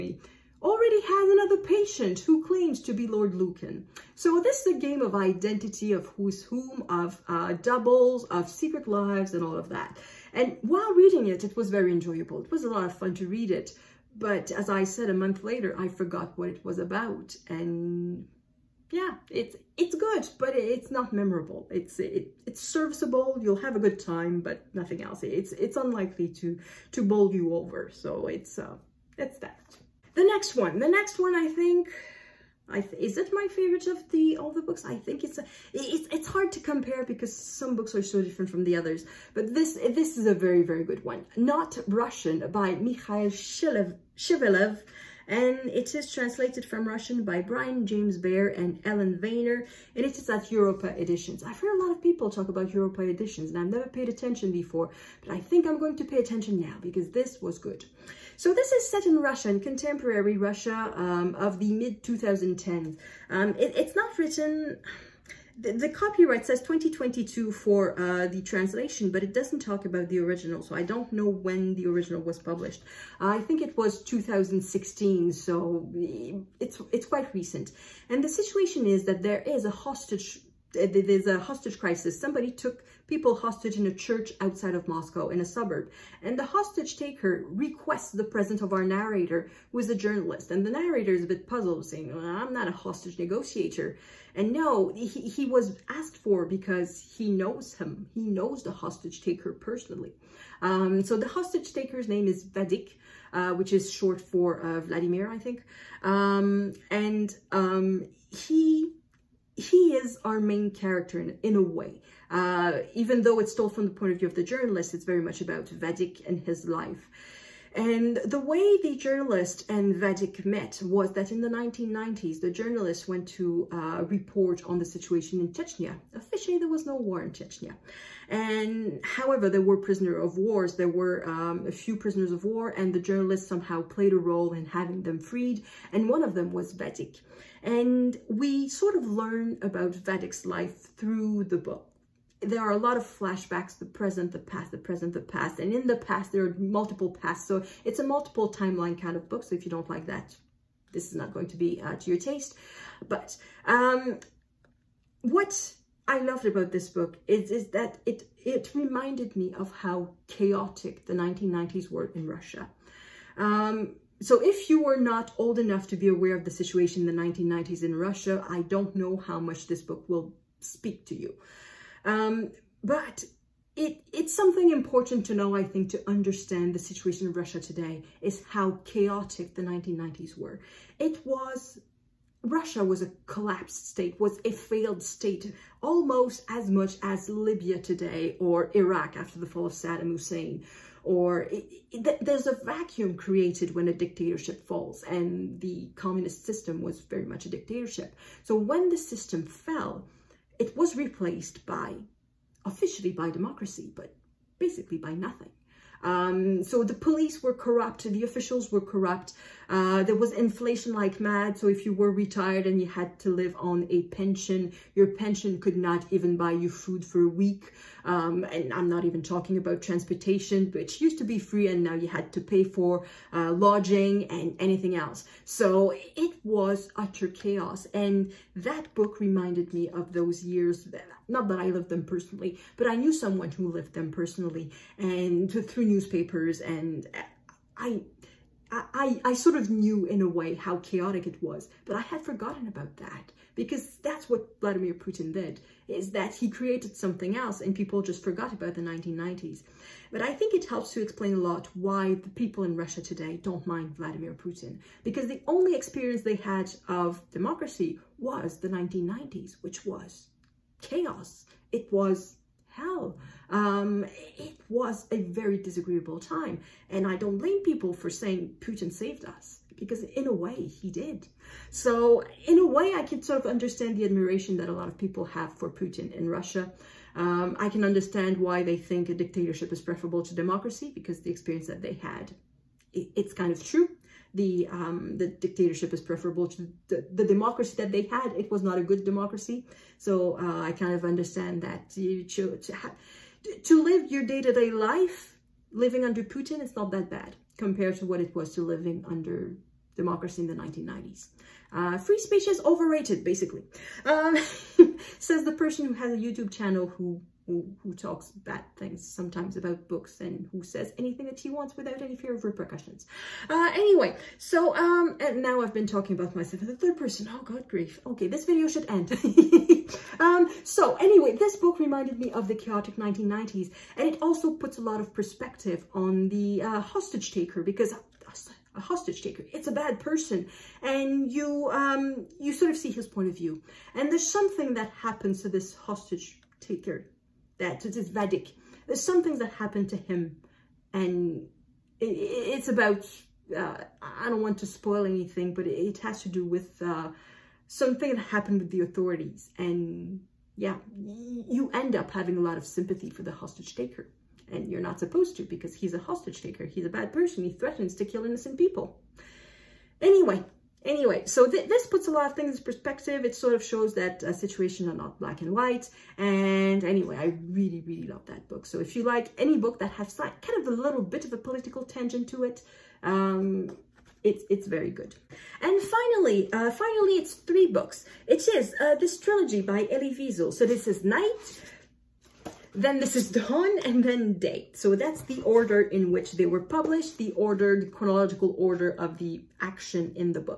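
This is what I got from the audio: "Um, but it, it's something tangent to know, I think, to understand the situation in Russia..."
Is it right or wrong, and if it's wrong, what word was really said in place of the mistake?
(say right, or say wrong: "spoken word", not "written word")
wrong: "important", not "tangent".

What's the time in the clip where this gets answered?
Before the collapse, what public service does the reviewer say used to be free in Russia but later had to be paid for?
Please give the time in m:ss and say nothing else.
3:39.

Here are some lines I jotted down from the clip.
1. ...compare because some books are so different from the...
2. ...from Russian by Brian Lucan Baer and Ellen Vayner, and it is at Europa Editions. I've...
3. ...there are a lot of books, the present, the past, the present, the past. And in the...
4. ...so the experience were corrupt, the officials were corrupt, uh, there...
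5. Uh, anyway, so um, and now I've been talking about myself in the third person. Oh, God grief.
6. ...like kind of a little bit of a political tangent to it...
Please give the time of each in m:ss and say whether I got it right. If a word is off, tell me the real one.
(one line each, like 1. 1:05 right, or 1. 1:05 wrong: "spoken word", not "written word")
1. 0:36 right
2. 0:46 wrong: "James", not "Lucan"
3. 2:22 wrong: "flashbacks", not "books"
4. 3:26 wrong: "police", not "experience"
5. 5:13 right
6. 6:10 right.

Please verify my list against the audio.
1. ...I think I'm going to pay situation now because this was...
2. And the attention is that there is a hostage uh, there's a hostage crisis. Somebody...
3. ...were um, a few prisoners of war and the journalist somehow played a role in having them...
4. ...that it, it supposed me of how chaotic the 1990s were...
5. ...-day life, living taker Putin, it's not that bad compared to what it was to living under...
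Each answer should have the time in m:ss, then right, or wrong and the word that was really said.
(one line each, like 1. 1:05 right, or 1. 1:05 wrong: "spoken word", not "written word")
1. 0:55 wrong: "attention", not "situation"
2. 1:18 wrong: "situation", not "attention"
3. 2:10 right
4. 2:37 wrong: "reminded", not "supposed"
5. 4:54 wrong: "under", not "taker".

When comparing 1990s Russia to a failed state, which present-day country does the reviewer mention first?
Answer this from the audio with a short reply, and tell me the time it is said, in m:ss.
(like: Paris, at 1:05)
Libya, at 3:07.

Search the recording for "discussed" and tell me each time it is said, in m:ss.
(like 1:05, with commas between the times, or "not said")
not said.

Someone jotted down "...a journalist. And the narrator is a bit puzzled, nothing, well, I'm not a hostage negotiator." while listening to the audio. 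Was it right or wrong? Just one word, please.
wrong.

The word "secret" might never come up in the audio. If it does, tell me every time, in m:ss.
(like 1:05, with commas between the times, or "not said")
0:08.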